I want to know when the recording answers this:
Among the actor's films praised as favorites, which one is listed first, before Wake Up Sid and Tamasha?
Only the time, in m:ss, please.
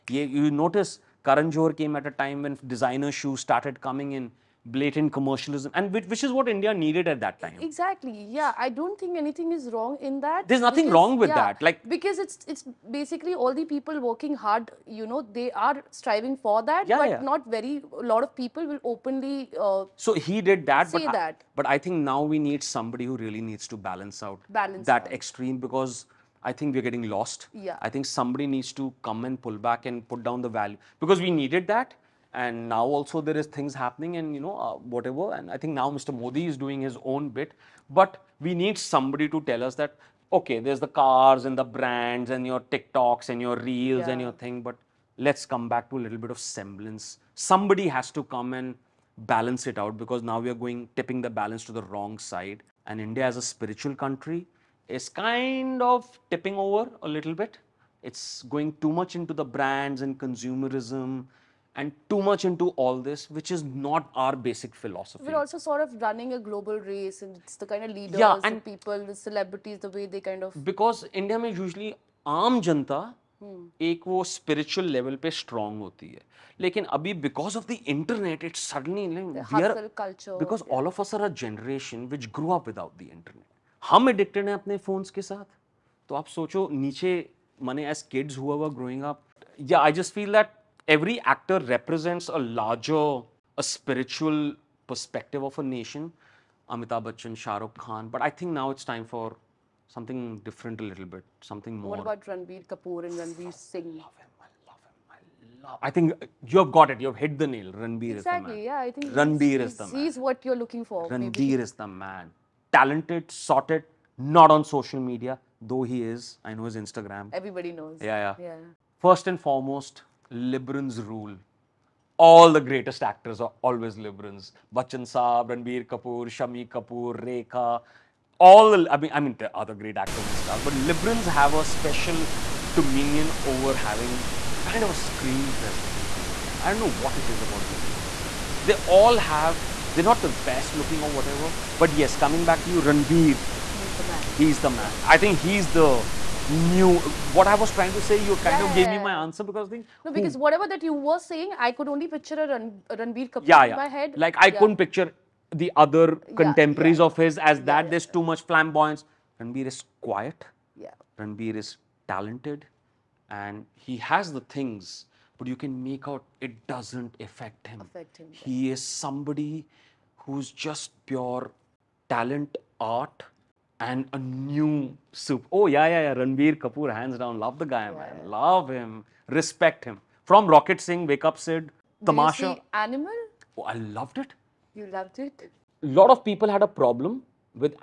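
3:00.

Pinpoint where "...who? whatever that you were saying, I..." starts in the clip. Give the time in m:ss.
2:30.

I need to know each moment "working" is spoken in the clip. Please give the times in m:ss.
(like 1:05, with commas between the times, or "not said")
0:13.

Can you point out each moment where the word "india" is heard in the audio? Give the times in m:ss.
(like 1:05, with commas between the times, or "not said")
0:06, 0:52, 1:11.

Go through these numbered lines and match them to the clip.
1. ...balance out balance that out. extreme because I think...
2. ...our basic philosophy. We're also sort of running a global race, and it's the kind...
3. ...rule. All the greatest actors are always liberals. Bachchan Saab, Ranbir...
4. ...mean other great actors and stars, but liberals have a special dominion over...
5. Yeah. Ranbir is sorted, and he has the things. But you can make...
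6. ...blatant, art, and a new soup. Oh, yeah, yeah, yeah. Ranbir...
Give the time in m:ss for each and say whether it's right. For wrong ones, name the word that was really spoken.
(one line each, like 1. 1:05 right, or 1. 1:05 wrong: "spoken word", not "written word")
1. 0:23 right
2. 1:04 right
3. 2:00 right
4. 2:09 right
5. 2:40 wrong: "talented", not "sorted"
6. 2:52 wrong: "talent", not "blatant".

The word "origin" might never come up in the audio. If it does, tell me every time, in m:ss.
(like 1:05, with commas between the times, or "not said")
not said.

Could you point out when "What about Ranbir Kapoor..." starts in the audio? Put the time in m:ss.
1:41.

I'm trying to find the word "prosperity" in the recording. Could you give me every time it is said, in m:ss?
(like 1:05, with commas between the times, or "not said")
not said.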